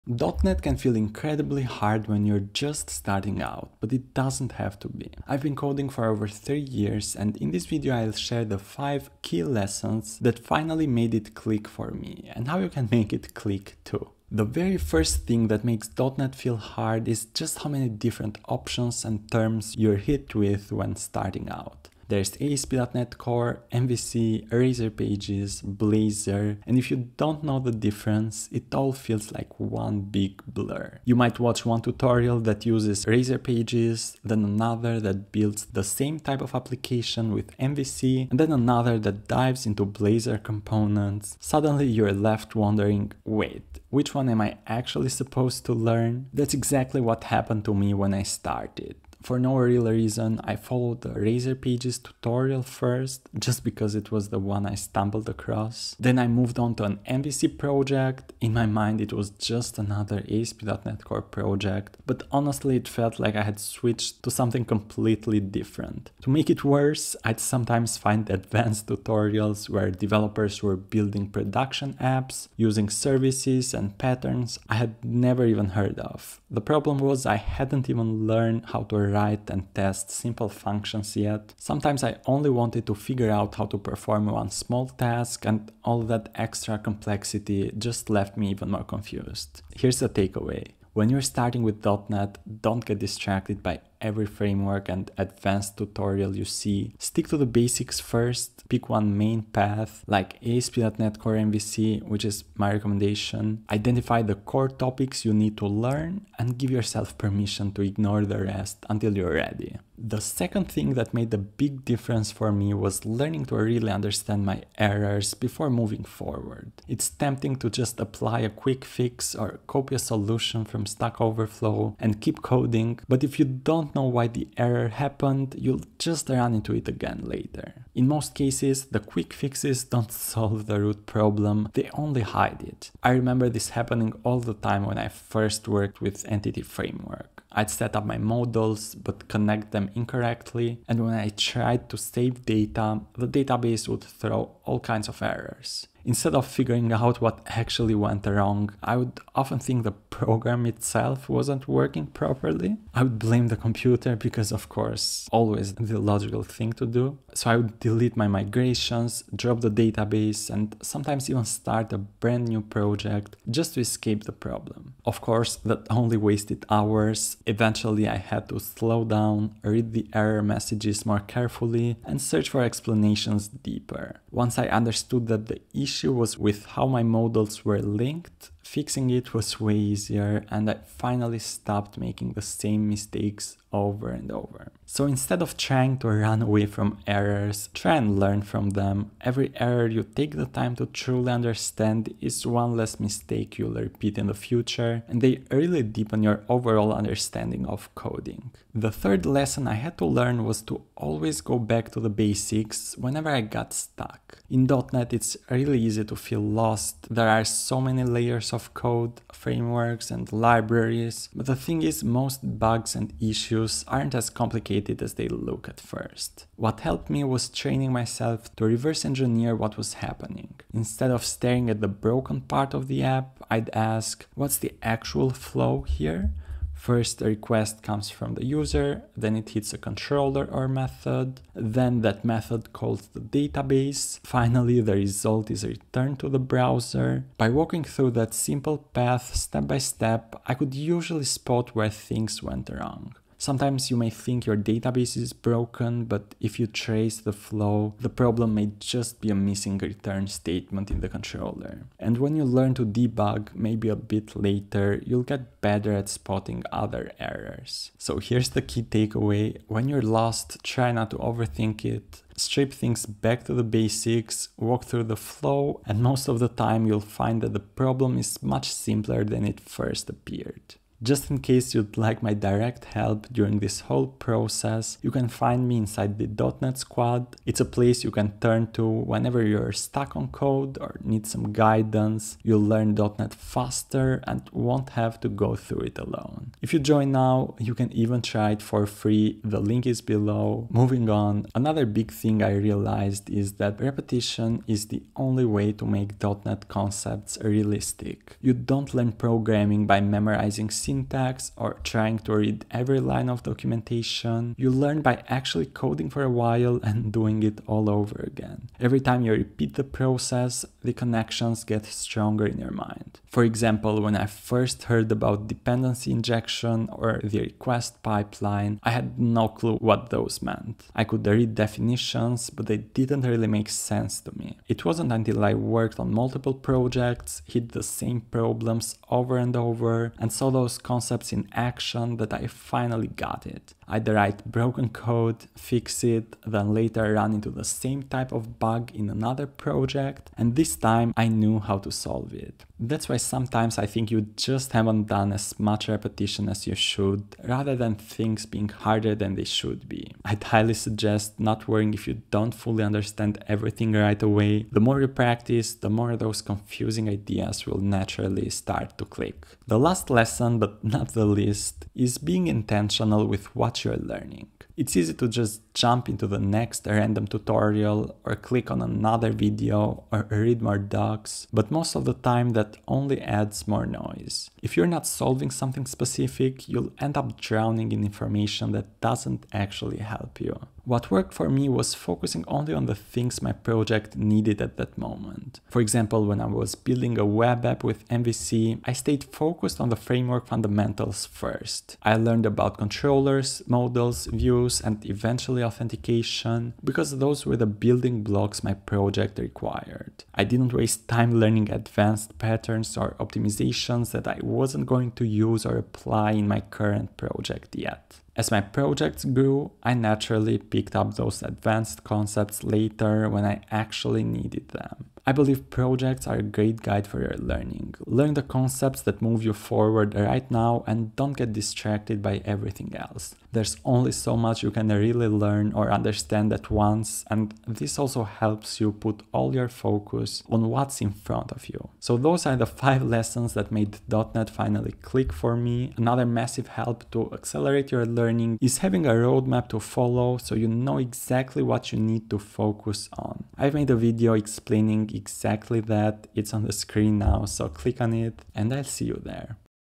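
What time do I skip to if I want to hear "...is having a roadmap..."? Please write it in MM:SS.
07:18.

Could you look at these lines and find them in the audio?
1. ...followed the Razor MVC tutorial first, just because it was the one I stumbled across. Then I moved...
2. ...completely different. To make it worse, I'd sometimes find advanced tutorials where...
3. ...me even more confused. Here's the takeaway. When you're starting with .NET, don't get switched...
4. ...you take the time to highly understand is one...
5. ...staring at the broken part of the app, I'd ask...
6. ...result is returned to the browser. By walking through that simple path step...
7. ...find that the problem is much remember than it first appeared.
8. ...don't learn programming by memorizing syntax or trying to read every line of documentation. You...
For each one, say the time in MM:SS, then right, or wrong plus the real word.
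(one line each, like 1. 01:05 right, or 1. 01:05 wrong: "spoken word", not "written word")
1. 00:50 wrong: "Pages", not "MVC"
2. 01:04 right
3. 01:28 wrong: "distracted", not "switched"
4. 03:09 wrong: "truly", not "highly"
5. 03:41 right
6. 03:54 right
7. 04:27 wrong: "simpler", not "remember"
8. 04:58 right.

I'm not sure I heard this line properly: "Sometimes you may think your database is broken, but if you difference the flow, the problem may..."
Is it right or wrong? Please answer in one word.
wrong.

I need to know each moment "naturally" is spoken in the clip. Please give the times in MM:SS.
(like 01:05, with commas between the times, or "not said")
05:57, 06:49.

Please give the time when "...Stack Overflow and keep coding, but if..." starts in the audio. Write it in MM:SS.
02:00.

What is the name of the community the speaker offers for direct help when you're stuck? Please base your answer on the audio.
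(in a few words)
.NET Squad.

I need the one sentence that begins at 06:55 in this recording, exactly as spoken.
I believe projects are a great guide for your learning.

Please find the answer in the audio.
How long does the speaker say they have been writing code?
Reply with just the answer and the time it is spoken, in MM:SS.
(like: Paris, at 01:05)
3 years, at 00:06.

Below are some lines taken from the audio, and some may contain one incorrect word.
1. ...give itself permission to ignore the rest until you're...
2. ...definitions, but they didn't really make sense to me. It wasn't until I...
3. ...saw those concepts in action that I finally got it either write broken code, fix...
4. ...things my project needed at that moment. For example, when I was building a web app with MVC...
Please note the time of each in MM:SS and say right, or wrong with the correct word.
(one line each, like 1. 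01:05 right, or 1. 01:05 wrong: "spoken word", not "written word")
1. 01:46 wrong: "yourself", not "itself"
2. 05:21 right
3. 05:30 right
4. 06:22 right.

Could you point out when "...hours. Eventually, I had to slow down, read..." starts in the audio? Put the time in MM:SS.
02:46.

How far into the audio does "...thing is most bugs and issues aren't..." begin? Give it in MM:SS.
03:31.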